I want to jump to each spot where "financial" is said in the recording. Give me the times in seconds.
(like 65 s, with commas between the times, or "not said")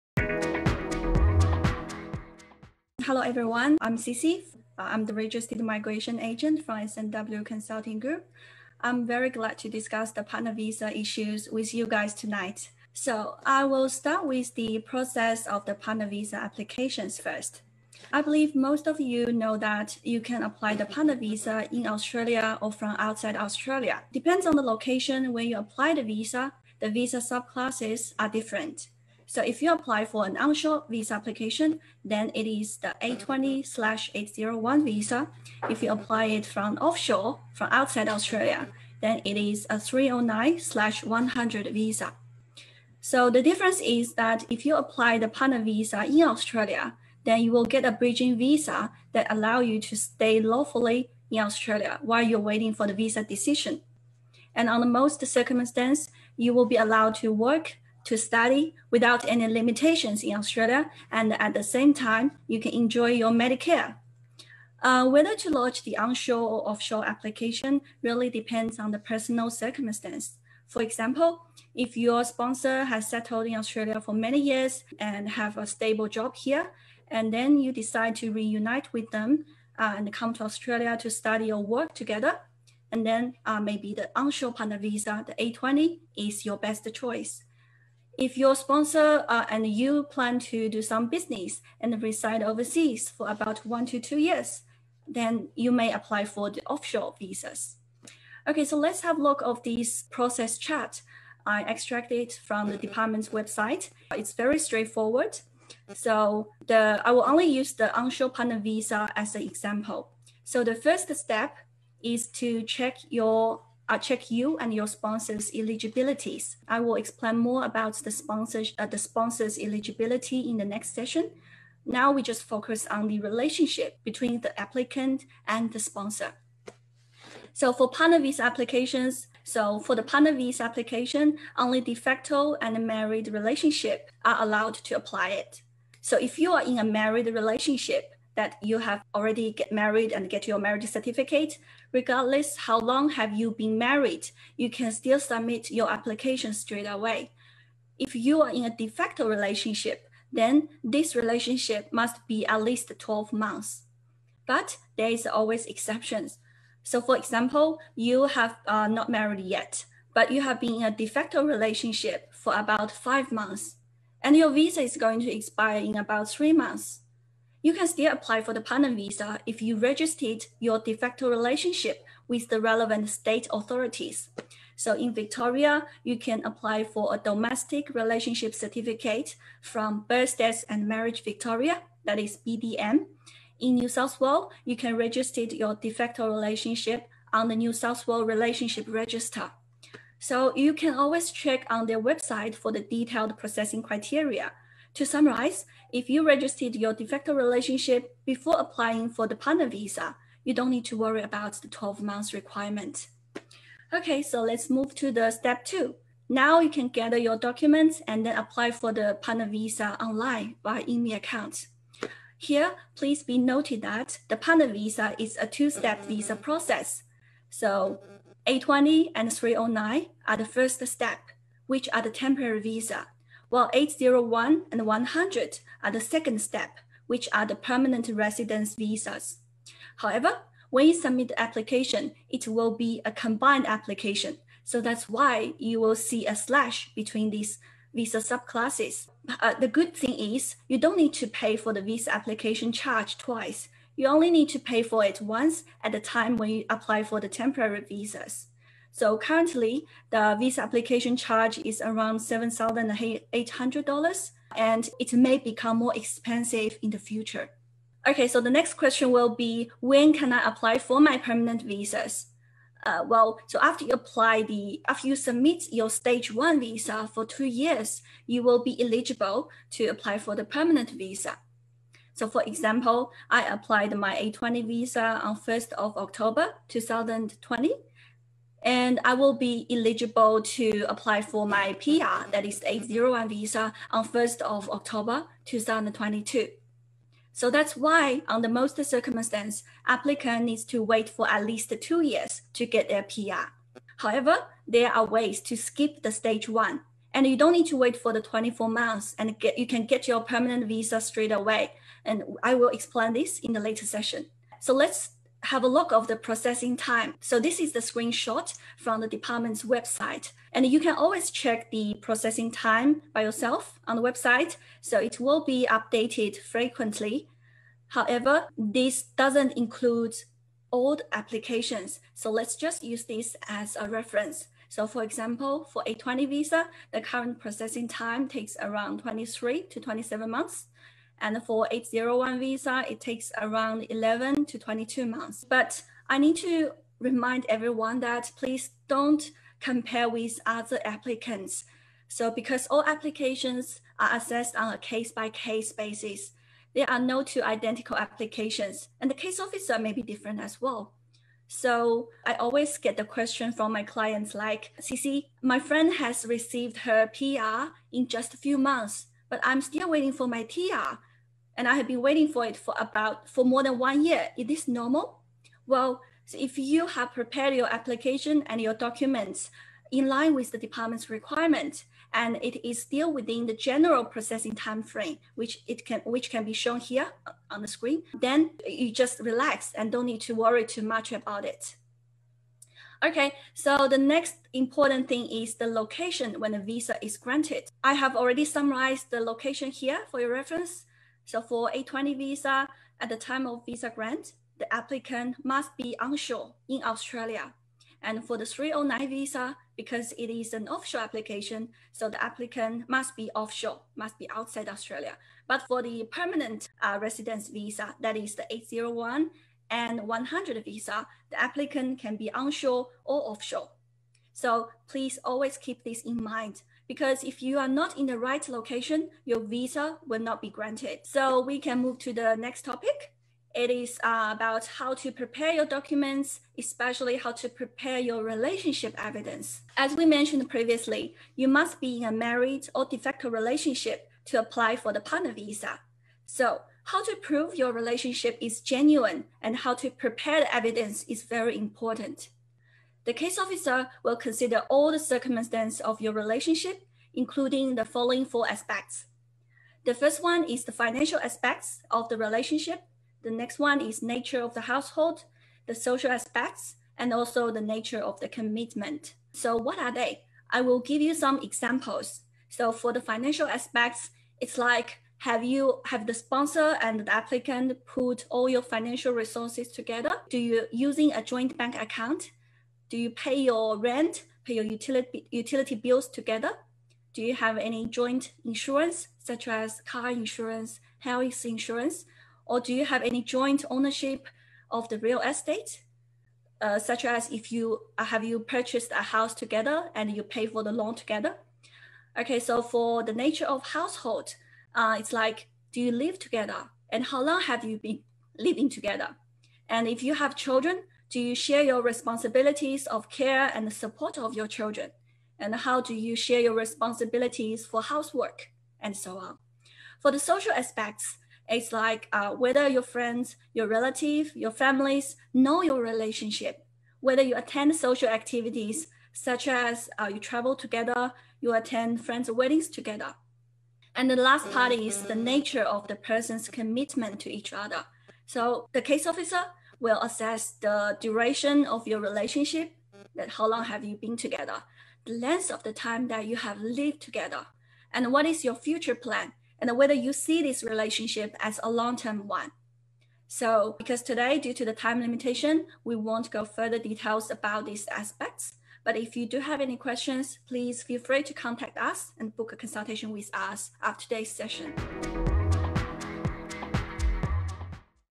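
450 s, 463 s, 468 s.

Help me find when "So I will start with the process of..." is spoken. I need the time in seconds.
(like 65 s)
12 s.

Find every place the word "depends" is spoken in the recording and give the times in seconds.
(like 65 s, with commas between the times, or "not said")
24 s, 68 s.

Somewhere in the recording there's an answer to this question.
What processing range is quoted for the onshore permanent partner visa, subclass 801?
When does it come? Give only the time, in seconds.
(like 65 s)
333 s.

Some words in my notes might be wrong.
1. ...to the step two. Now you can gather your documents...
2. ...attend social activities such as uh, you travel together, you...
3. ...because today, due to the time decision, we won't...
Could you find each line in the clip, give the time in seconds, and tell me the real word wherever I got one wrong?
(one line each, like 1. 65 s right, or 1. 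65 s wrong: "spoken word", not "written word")
1. 204 s right
2. 517 s right
3. 543 s wrong: "limitation", not "decision".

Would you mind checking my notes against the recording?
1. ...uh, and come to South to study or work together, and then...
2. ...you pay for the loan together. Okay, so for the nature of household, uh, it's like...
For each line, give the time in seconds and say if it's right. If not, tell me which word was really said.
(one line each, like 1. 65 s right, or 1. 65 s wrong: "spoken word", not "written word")
1. 79 s wrong: "Australia", not "South"
2. 490 s right.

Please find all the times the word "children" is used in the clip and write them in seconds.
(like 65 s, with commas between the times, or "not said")
500 s, 504 s.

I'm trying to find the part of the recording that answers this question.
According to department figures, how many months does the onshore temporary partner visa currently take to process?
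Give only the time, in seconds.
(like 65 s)
329 s.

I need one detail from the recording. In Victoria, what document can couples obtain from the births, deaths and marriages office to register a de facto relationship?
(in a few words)
domestic relationship certificate.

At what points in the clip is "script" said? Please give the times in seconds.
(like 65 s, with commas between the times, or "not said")
not said.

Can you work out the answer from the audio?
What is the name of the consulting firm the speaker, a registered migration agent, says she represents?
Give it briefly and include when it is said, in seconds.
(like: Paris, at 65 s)
SNW Consulting Group, at 6 s.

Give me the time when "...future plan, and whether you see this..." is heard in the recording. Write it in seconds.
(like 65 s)
538 s.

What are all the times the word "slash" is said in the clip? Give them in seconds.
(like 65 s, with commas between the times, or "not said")
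33 s, 40 s, 236 s.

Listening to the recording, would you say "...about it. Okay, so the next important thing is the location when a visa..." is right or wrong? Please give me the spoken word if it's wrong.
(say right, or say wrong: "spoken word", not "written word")
right.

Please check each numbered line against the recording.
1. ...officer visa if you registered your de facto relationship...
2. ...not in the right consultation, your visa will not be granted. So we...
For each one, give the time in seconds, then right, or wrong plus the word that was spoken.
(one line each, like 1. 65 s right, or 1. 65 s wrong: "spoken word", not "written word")
1. 168 s wrong: "partner", not "officer"
2. 417 s wrong: "location", not "consultation".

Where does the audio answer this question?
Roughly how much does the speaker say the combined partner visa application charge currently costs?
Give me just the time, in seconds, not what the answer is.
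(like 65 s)
252 s.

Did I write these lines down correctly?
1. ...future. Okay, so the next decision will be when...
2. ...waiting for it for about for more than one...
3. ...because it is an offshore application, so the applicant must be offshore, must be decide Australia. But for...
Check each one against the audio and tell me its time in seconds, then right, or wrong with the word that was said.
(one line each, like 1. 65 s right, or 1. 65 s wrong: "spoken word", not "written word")
1. 256 s wrong: "question", not "decision"
2. 362 s right
3. 399 s wrong: "outside", not "decide".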